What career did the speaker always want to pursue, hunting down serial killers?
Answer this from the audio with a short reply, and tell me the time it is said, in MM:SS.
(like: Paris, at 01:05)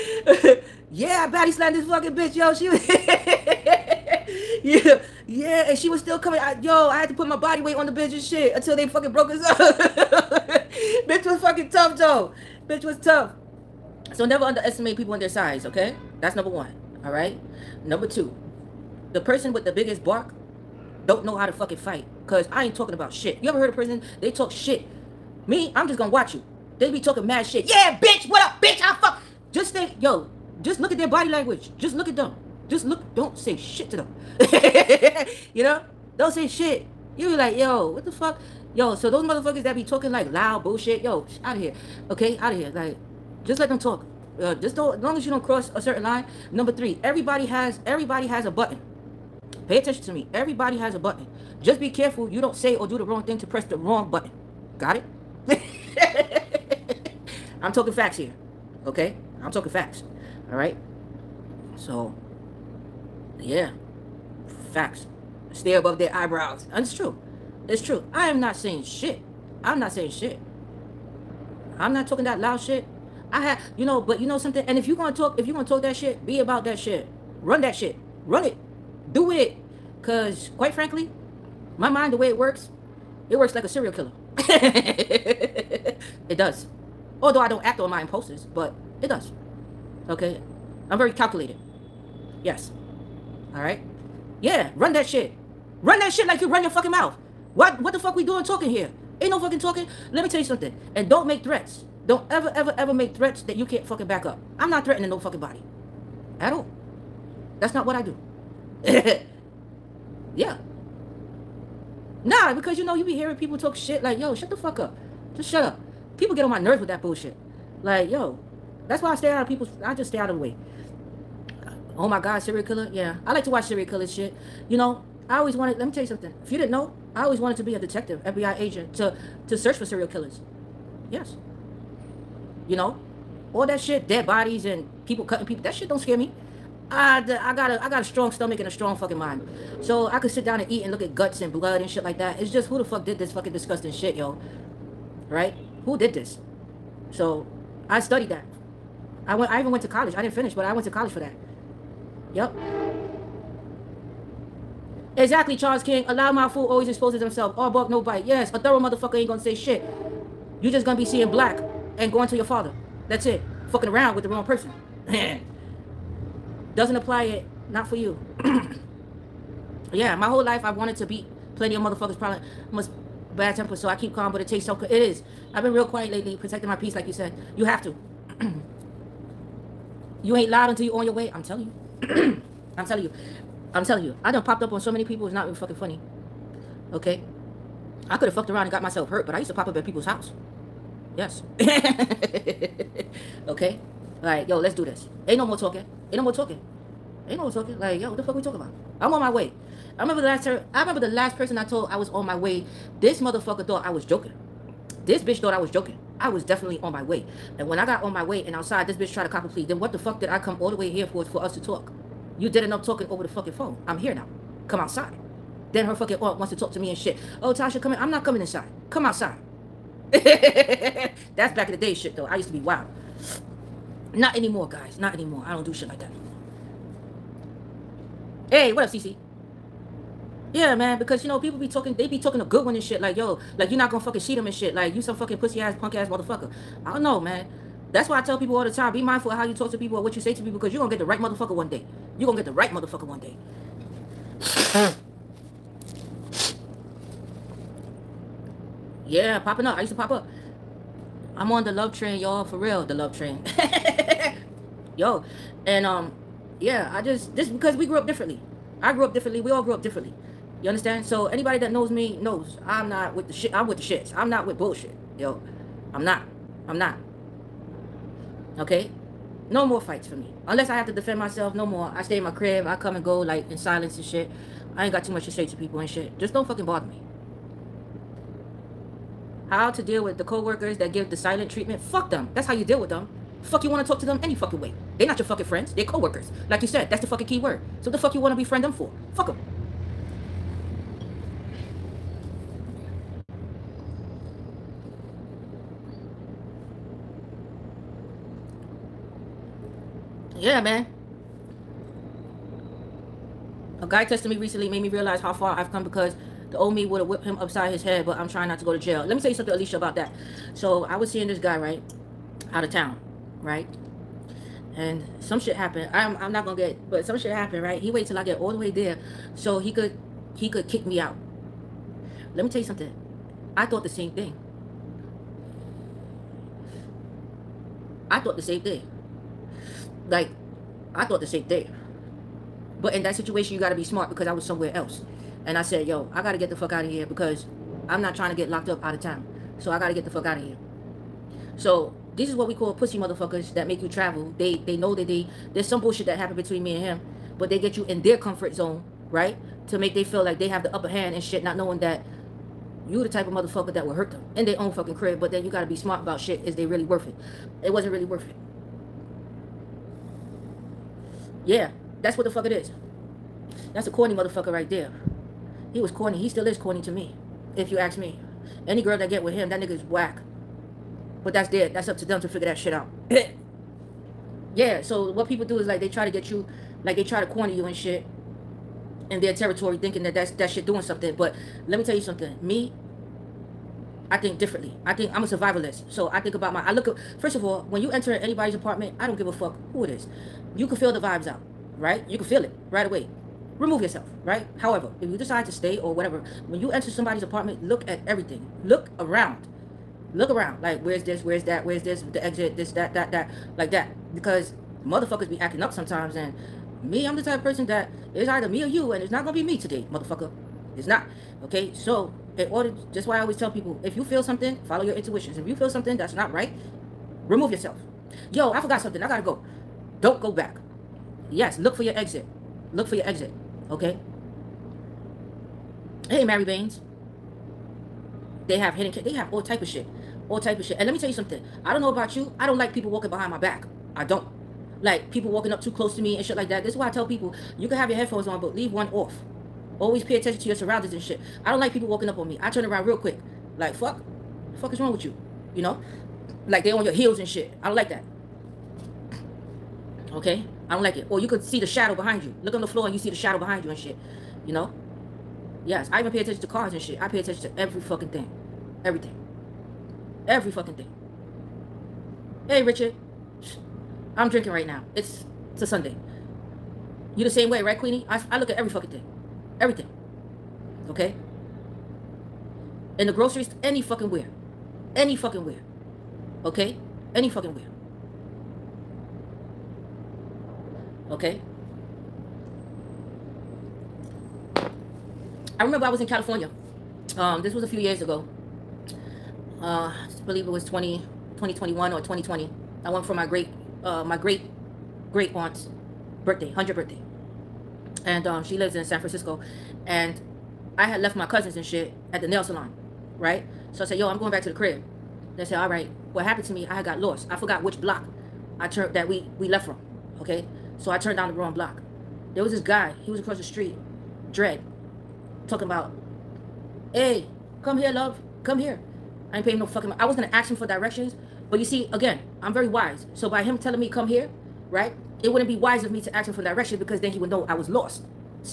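FBI agent, at 02:08.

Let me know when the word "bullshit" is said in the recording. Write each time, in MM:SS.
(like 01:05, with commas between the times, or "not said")
00:40, 01:57, 04:24, 05:45.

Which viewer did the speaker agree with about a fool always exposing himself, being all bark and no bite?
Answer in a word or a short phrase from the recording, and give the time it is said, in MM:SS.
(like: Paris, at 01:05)
Charles King, at 02:35.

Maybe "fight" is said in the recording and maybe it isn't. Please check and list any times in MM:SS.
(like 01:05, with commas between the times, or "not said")
00:21, 04:29.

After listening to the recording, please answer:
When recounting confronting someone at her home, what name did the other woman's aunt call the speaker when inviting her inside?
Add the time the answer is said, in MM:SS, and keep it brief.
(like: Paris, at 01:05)
Tasha, at 03:37.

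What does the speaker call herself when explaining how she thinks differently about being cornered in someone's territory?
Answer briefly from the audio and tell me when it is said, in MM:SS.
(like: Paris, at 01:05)
A survivalist, at 06:25.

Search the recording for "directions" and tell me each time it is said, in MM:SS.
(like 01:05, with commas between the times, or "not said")
08:40, 08:46.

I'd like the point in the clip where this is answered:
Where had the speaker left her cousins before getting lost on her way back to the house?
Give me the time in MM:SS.
08:22.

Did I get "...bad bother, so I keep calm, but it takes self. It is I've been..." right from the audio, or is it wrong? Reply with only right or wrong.
wrong.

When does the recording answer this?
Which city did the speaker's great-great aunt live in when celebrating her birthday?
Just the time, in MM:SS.
08:18.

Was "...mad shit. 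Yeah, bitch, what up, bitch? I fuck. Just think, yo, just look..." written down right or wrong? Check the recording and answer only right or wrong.
right.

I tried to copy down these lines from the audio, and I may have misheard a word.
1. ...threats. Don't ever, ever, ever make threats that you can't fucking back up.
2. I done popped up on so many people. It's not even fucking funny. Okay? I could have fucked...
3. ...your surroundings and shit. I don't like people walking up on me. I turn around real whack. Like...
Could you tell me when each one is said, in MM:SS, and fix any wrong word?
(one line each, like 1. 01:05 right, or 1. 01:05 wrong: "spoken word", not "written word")
1. 01:41 right
2. 03:04 right
3. 07:20 wrong: "quick", not "whack".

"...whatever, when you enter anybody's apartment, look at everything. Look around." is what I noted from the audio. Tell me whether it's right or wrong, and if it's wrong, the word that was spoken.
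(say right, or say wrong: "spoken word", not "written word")
wrong: "somebody", not "anybody".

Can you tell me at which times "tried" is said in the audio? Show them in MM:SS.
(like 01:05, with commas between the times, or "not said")
03:29.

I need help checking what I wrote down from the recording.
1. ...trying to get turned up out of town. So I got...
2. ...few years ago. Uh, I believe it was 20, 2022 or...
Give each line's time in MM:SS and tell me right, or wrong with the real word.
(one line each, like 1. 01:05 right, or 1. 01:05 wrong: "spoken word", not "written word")
1. 05:38 wrong: "locked", not "turned"
2. 08:07 wrong: "2021", not "2022".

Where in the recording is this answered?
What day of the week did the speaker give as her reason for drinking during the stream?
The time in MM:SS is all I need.
07:45.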